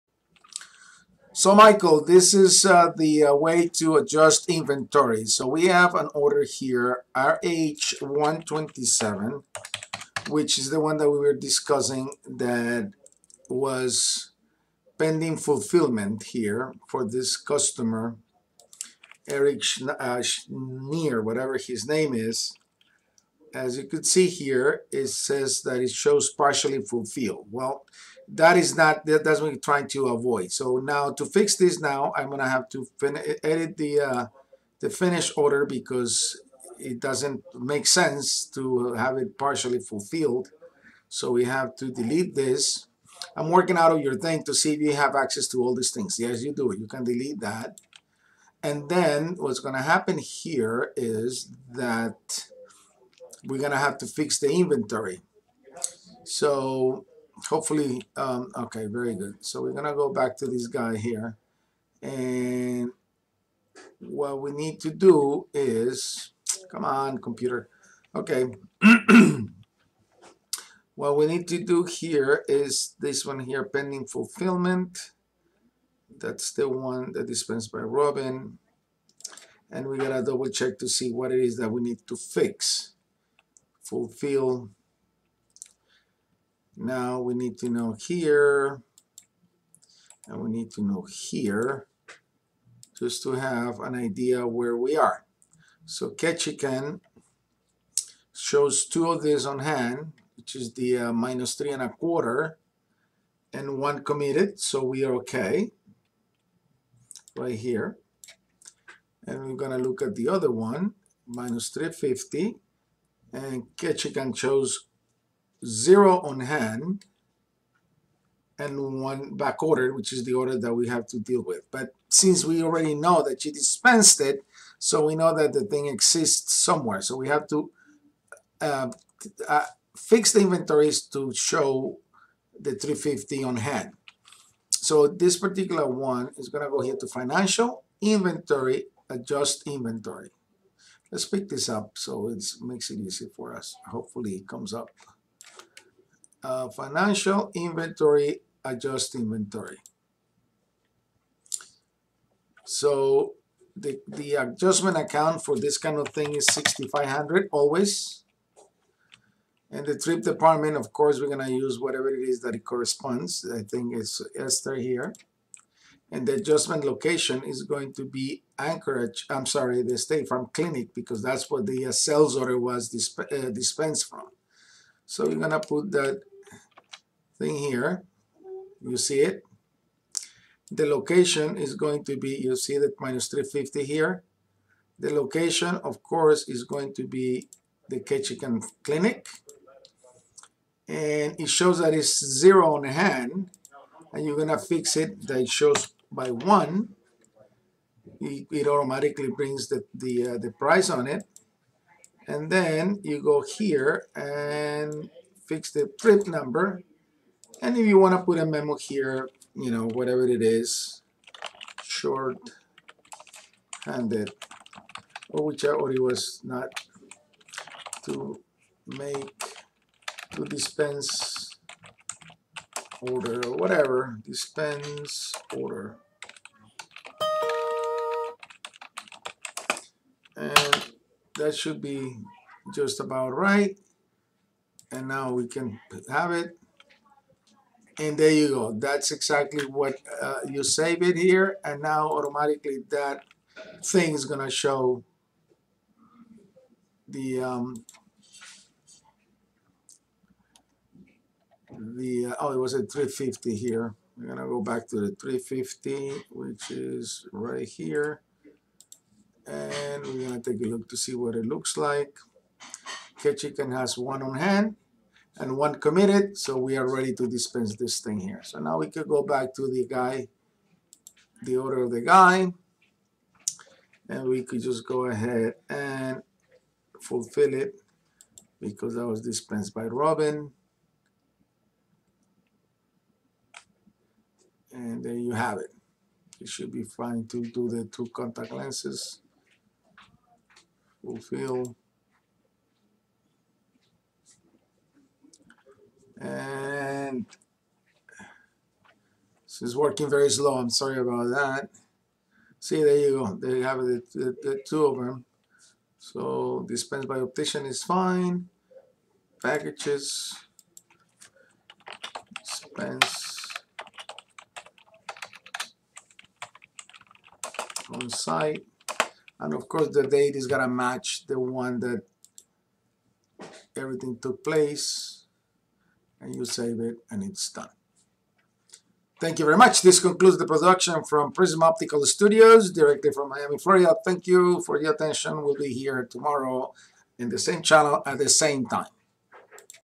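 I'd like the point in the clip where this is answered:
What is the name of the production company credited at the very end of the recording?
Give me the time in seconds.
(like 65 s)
331 s.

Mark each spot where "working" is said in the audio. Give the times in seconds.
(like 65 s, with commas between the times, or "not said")
43 s, 299 s.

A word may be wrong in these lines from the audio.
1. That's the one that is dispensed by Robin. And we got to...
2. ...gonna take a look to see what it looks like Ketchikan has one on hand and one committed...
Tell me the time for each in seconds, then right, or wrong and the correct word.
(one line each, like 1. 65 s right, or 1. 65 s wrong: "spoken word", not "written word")
1. 76 s right
2. 260 s right.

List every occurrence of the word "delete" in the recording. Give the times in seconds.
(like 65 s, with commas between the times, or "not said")
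41 s, 47 s.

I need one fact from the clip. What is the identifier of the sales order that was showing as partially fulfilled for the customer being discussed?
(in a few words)
RH127.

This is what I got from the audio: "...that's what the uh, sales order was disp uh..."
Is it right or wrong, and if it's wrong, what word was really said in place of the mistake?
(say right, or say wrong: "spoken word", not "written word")
right.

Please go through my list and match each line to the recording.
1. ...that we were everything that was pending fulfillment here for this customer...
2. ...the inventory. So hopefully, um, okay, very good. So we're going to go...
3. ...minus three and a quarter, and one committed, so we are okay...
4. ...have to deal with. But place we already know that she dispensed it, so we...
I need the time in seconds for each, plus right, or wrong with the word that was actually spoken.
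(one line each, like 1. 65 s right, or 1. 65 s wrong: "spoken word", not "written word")
1. 10 s wrong: "discussing", not "everything"
2. 54 s right
3. 101 s right
4. 120 s wrong: "since", not "place".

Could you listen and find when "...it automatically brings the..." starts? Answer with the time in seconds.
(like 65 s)
198 s.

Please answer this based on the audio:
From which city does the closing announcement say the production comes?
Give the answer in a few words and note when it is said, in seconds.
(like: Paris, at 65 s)
Miami, Florida, at 333 s.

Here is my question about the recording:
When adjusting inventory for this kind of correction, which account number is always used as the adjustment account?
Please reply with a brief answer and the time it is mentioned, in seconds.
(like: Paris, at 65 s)
6500, at 156 s.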